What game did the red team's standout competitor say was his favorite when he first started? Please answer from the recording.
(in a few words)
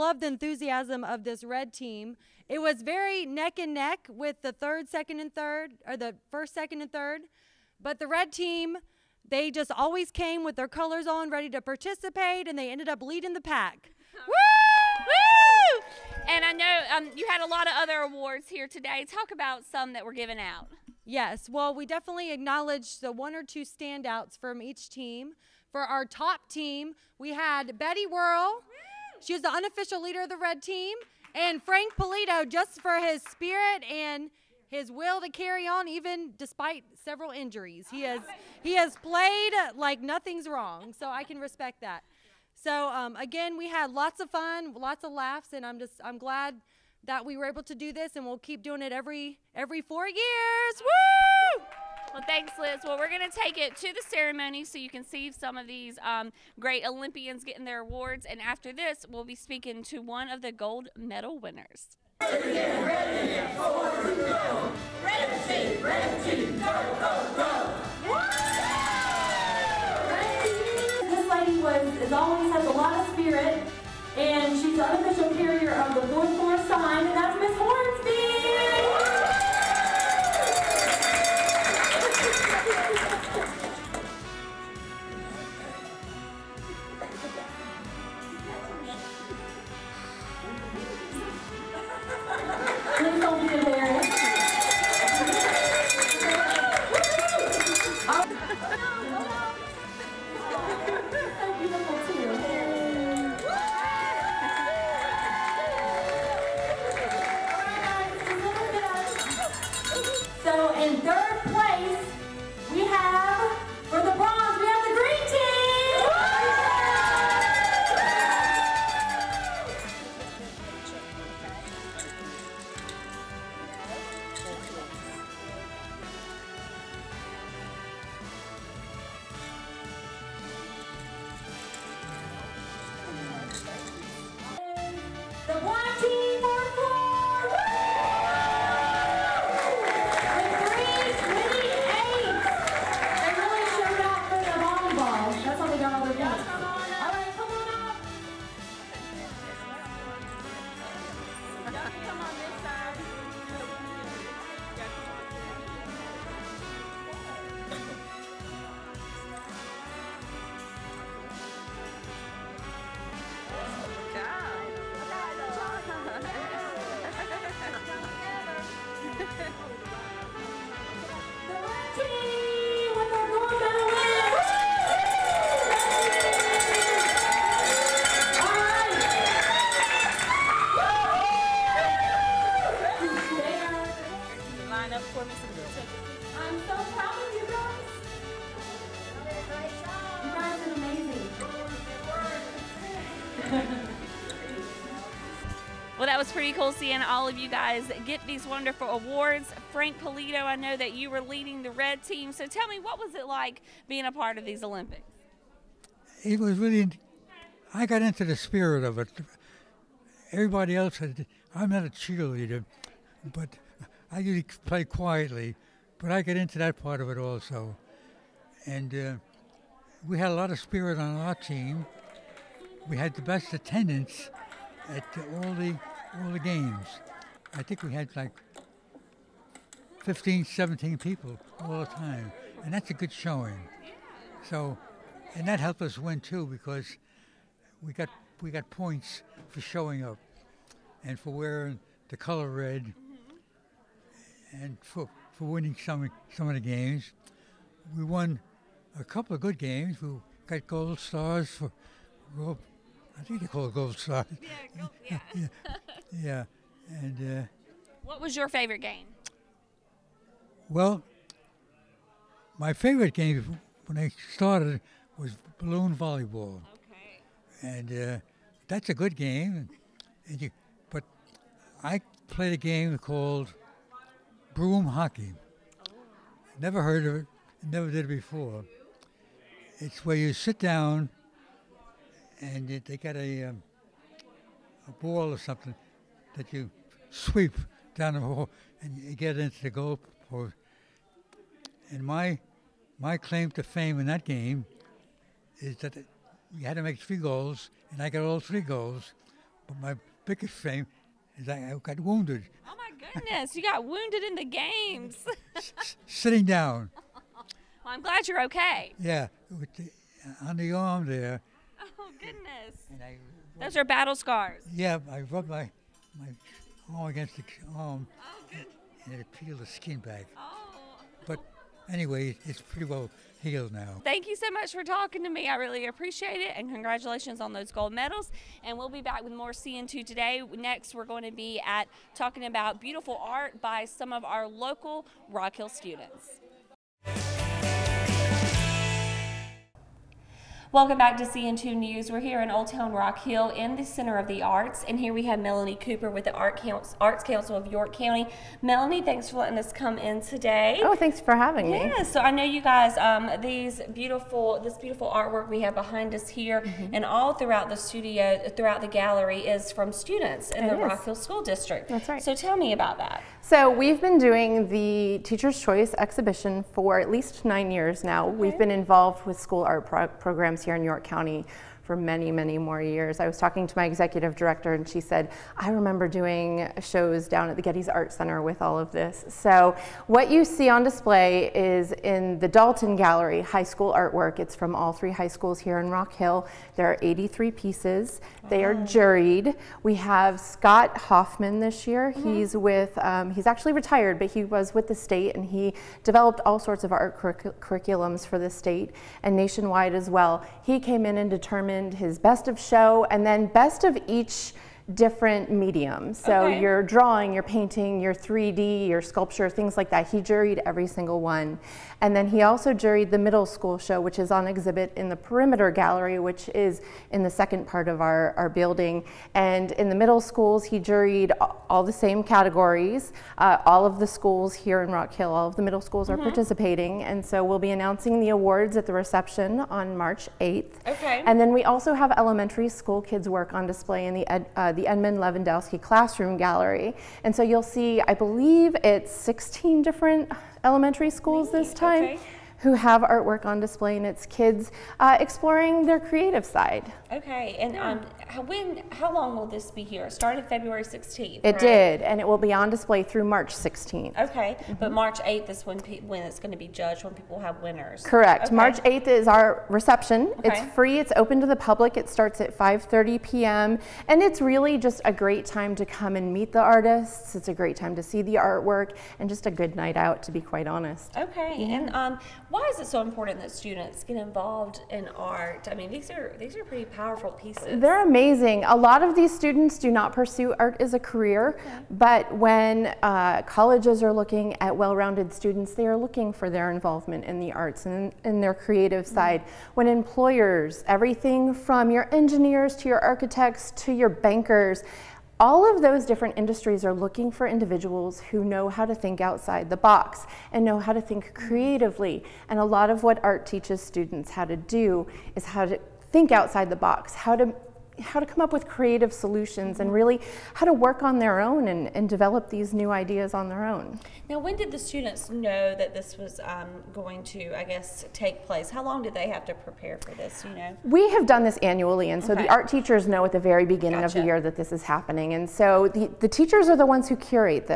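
balloon volleyball.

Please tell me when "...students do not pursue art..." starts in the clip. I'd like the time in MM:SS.
07:59.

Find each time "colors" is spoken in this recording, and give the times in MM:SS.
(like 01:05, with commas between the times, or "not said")
00:10, 04:02.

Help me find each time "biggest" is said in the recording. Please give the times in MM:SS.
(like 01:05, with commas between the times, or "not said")
05:00.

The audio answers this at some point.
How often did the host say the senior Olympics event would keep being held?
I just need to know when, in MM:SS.
00:48.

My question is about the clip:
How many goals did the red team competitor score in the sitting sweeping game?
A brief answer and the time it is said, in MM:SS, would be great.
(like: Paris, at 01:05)
3, at 04:58.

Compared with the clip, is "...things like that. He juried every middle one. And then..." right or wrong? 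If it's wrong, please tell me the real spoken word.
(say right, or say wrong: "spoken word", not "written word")
wrong: "single", not "middle".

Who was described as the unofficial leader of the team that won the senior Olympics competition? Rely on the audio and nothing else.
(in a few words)
Betty Whirl.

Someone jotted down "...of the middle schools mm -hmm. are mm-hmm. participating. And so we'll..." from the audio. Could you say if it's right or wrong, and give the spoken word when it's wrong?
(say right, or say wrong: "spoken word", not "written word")
right.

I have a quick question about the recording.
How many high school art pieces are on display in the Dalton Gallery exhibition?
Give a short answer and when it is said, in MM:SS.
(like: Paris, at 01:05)
83, at 06:27.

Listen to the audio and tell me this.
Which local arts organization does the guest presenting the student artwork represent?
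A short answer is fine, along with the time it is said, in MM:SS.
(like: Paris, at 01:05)
Arts Council of York County, at 05:47.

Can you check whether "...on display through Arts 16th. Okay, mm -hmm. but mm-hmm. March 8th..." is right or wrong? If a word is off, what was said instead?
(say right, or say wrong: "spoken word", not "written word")
wrong: "March", not "Arts".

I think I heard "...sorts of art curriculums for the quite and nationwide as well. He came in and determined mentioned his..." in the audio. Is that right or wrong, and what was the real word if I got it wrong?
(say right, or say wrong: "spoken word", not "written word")
wrong: "state", not "quite".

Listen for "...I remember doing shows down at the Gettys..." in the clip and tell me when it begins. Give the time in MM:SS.
06:15.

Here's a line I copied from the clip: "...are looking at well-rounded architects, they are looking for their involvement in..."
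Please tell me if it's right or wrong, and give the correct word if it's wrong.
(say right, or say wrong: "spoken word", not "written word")
wrong: "students", not "architects".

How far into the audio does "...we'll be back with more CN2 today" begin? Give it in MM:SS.
05:28.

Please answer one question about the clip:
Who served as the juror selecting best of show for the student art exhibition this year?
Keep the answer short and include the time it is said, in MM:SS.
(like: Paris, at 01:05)
Scott Hoffman, at 06:30.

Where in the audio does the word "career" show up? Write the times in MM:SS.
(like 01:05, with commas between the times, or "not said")
08:00.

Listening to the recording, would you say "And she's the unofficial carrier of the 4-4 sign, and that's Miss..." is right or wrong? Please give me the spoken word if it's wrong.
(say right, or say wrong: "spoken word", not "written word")
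right.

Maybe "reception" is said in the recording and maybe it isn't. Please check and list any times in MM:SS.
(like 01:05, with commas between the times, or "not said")
07:08, 07:39.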